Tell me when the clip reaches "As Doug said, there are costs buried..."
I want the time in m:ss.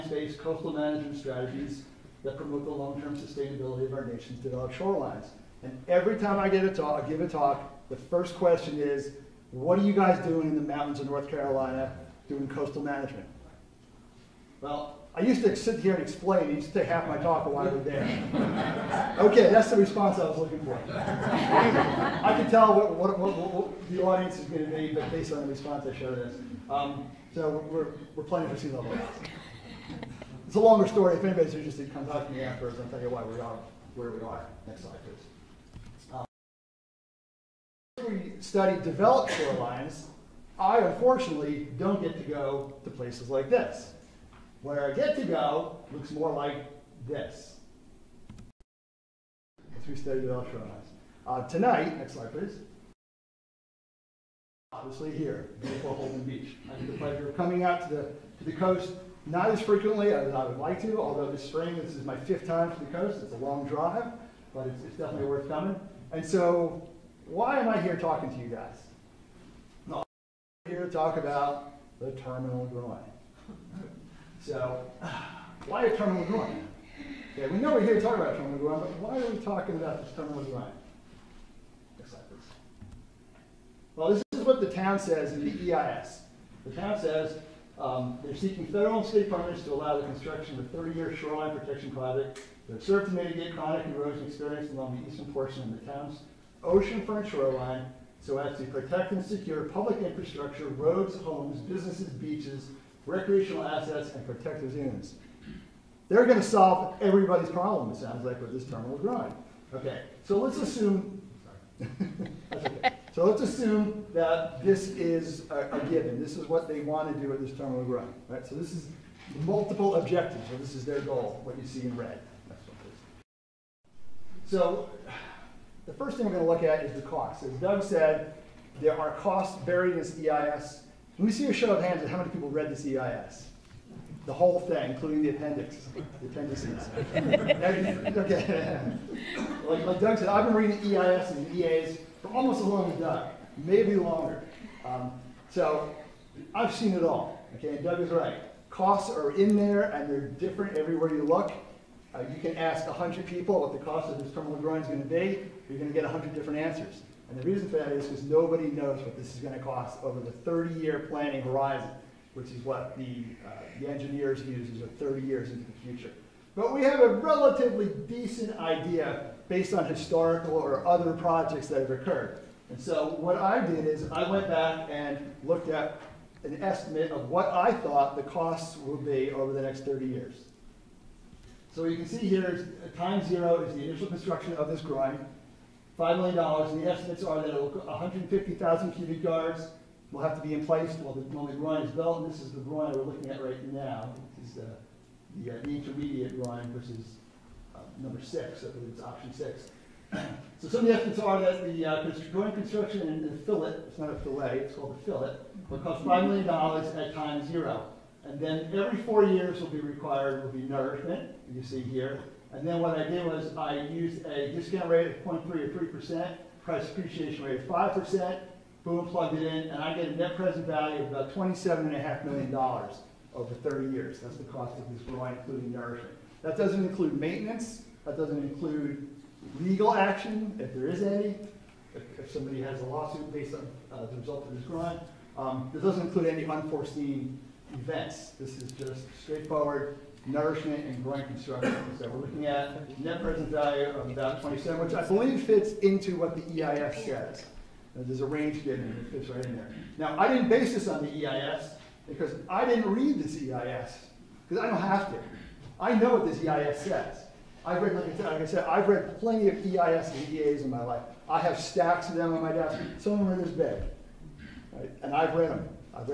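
2:07.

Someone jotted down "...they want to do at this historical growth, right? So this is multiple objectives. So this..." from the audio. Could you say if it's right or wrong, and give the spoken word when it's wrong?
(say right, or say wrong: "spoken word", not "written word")
wrong: "terminal", not "historical".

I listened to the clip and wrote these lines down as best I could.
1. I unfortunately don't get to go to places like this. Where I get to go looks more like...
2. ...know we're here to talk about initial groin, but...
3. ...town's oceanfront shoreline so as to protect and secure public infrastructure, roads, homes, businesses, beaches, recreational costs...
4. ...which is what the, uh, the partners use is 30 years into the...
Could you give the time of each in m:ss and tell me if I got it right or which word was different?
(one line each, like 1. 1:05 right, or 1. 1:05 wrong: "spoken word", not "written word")
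1. 0:40 right
2. 1:17 wrong: "terminal", not "initial"
3. 1:35 wrong: "assets", not "costs"
4. 2:42 wrong: "engineers", not "partners".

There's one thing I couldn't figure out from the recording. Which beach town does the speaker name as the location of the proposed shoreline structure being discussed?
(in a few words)
Holden Beach.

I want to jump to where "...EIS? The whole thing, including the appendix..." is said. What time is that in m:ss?
2:12.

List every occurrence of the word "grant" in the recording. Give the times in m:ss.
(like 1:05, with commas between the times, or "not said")
3:54, 4:01.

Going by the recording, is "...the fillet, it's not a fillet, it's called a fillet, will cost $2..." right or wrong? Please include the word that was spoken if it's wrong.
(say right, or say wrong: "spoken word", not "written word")
wrong: "5", not "2".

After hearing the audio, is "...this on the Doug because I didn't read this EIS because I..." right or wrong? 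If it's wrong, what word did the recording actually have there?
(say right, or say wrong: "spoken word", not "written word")
wrong: "EIS", not "Doug".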